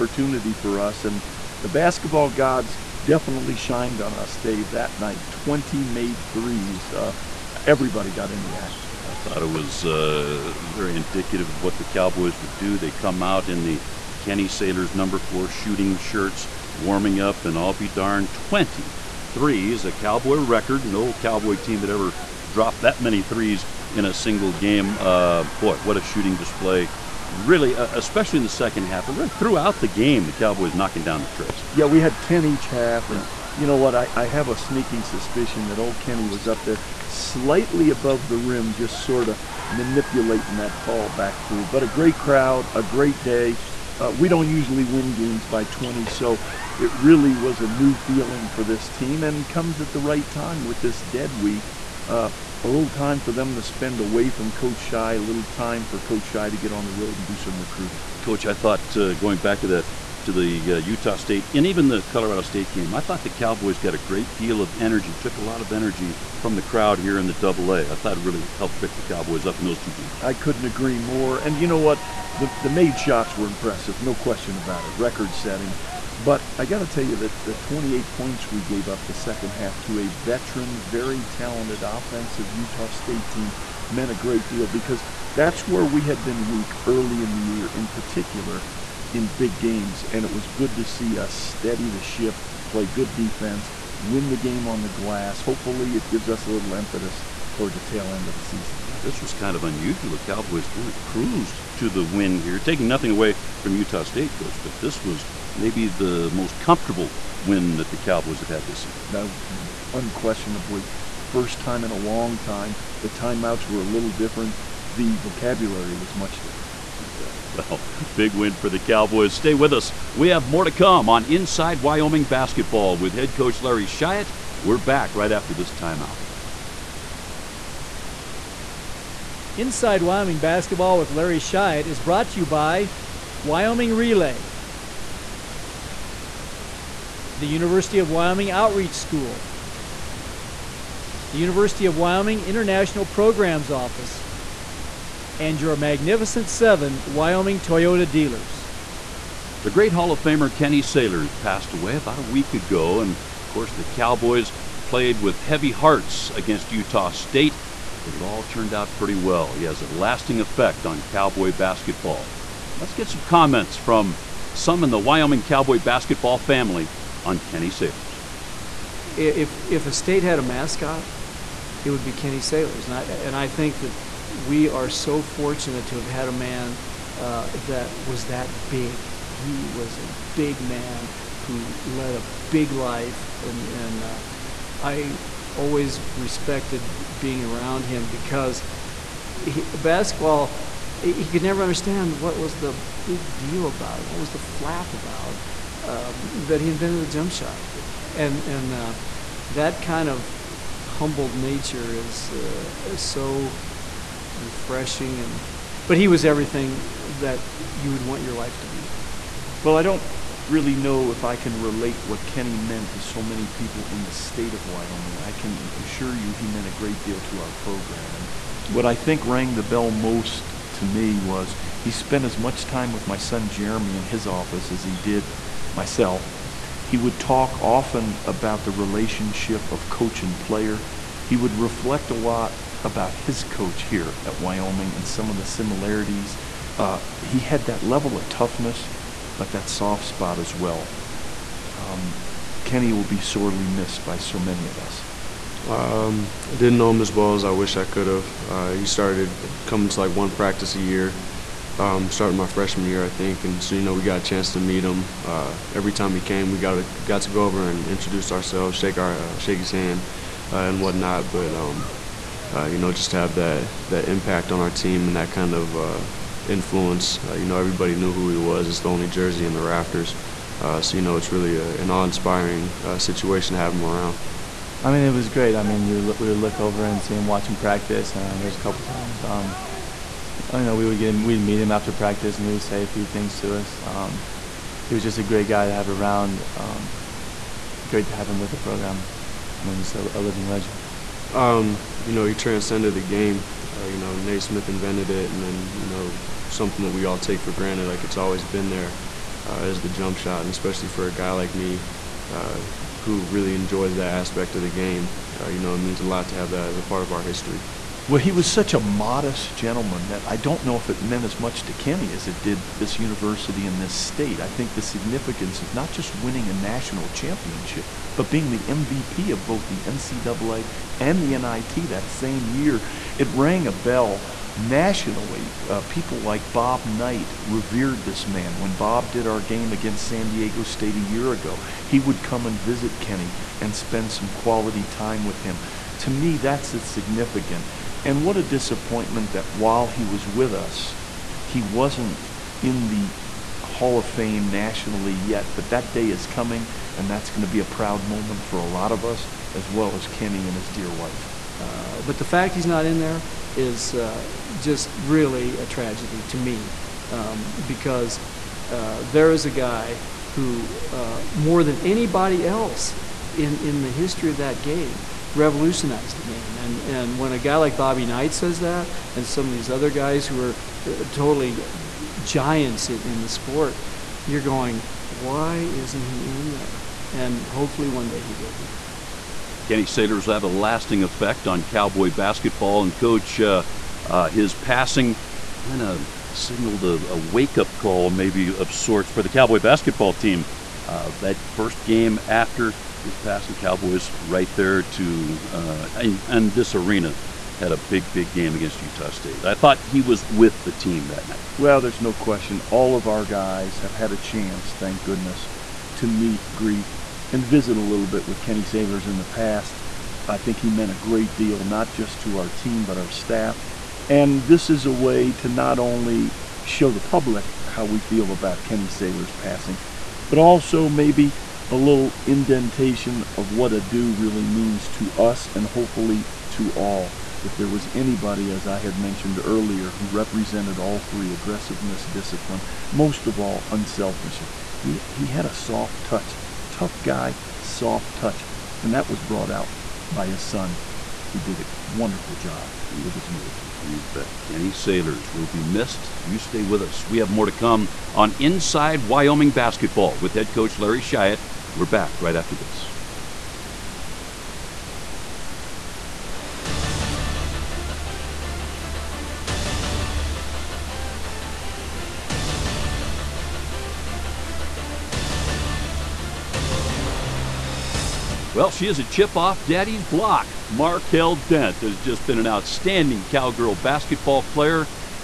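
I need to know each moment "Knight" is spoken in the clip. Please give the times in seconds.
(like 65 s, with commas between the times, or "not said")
326 s, 368 s.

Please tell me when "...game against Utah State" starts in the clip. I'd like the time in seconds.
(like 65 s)
398 s.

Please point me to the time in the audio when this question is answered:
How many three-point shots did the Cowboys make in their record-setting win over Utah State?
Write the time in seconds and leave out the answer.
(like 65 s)
5 s.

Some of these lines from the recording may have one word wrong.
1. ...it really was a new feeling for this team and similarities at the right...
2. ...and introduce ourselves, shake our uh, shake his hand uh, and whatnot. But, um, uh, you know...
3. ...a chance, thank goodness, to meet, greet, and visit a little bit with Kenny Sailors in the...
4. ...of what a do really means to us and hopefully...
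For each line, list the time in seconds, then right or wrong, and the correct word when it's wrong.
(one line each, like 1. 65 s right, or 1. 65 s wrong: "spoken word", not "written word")
1. 46 s wrong: "comes", not "similarities"
2. 257 s right
3. 404 s right
4. 423 s right.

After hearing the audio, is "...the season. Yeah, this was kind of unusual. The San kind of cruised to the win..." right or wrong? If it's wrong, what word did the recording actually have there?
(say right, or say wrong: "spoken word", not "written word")
wrong: "Cowboys", not "San".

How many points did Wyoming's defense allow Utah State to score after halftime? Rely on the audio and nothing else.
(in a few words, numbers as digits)
28.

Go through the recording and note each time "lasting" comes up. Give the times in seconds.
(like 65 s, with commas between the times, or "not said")
159 s, 380 s.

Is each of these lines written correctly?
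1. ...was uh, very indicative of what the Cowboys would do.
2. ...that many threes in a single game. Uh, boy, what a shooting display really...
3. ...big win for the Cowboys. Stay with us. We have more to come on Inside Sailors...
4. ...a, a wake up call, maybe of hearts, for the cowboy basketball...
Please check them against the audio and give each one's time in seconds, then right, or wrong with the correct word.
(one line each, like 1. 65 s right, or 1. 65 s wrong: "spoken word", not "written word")
1. 9 s right
2. 22 s right
3. 118 s wrong: "Wyoming", not "Sailors"
4. 386 s wrong: "sorts", not "hearts".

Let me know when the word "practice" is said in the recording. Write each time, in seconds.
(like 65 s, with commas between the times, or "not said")
250 s, 277 s, 281 s.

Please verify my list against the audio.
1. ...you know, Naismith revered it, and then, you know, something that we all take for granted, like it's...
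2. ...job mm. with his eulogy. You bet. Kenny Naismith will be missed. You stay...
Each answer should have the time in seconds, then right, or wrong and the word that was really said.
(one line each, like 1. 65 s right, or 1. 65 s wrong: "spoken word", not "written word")
1. 293 s wrong: "invented", not "revered"
2. 442 s wrong: "Sailors", not "Naismith".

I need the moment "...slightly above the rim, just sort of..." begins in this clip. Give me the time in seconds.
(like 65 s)
37 s.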